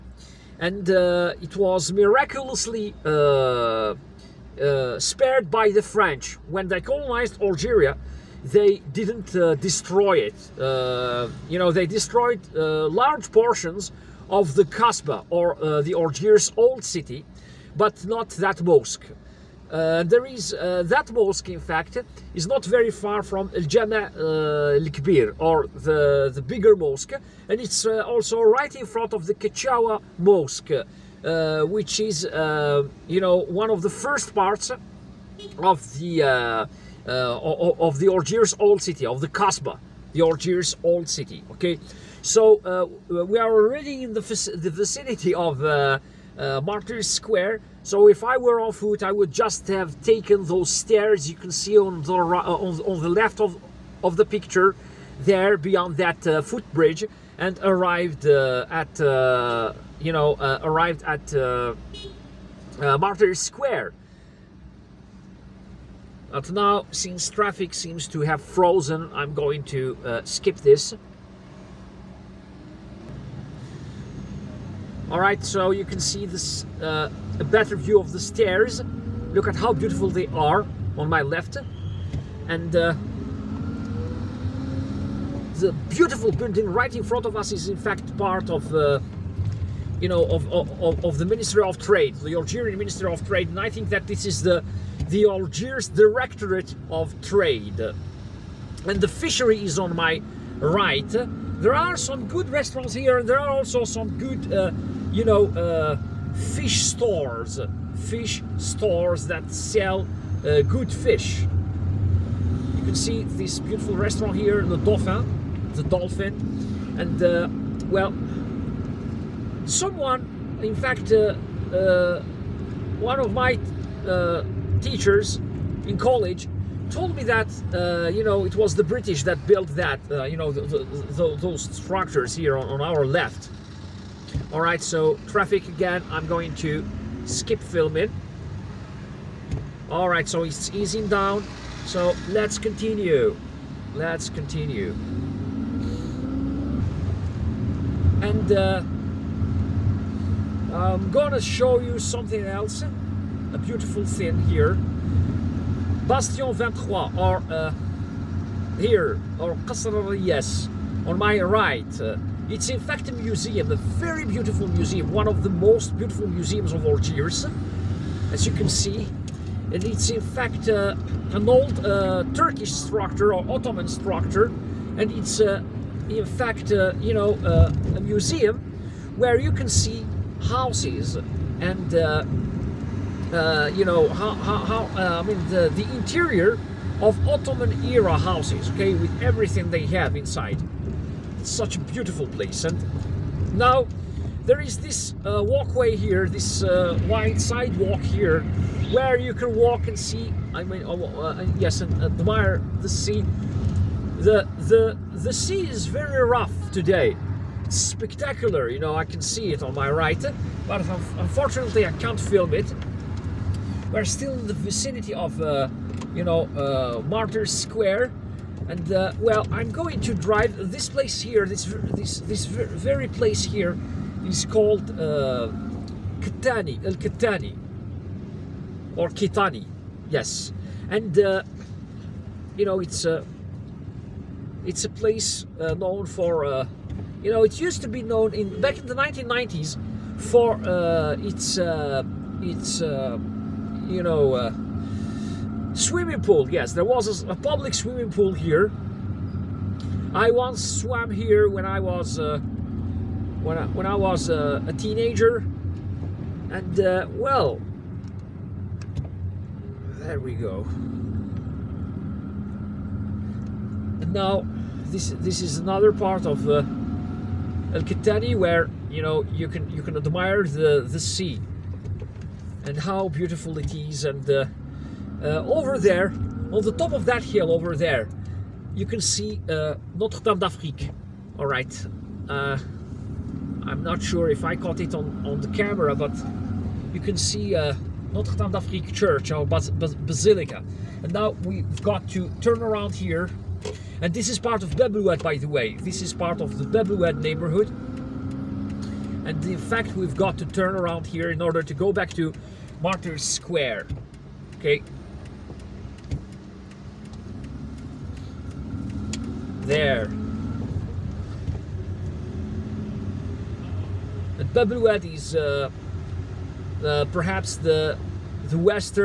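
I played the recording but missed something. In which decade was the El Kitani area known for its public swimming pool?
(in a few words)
1990s.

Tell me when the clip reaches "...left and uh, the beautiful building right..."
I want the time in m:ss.
1:21.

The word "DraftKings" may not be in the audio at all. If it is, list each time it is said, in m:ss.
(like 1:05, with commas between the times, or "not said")
not said.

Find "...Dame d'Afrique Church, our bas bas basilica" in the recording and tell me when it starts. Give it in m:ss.
4:48.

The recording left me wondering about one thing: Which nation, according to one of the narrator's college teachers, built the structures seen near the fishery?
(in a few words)
the British.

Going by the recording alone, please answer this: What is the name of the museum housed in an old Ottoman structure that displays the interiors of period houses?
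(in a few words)
Bastion 23.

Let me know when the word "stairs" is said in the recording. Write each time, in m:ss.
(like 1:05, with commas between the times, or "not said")
0:50, 1:18.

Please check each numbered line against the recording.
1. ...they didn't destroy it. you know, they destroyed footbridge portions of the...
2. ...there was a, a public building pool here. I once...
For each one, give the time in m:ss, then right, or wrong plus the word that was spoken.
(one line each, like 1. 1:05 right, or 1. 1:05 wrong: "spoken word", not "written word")
1. 0:08 wrong: "large", not "footbridge"
2. 4:06 wrong: "swimming", not "building".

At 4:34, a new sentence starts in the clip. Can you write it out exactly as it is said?
Uh, uh, over there, on the top of that hill over there, you can see uh, Notre Dame d'Afrique.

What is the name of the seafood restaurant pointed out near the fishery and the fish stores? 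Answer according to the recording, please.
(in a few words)
Dauphin (the Dolphin).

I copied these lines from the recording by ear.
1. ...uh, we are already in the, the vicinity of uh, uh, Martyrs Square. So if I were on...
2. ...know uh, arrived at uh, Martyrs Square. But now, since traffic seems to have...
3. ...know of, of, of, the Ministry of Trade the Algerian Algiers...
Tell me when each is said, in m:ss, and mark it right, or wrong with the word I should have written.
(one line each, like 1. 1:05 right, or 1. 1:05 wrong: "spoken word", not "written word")
1. 0:42 right
2. 1:00 right
3. 1:30 wrong: "Ministry", not "Algiers".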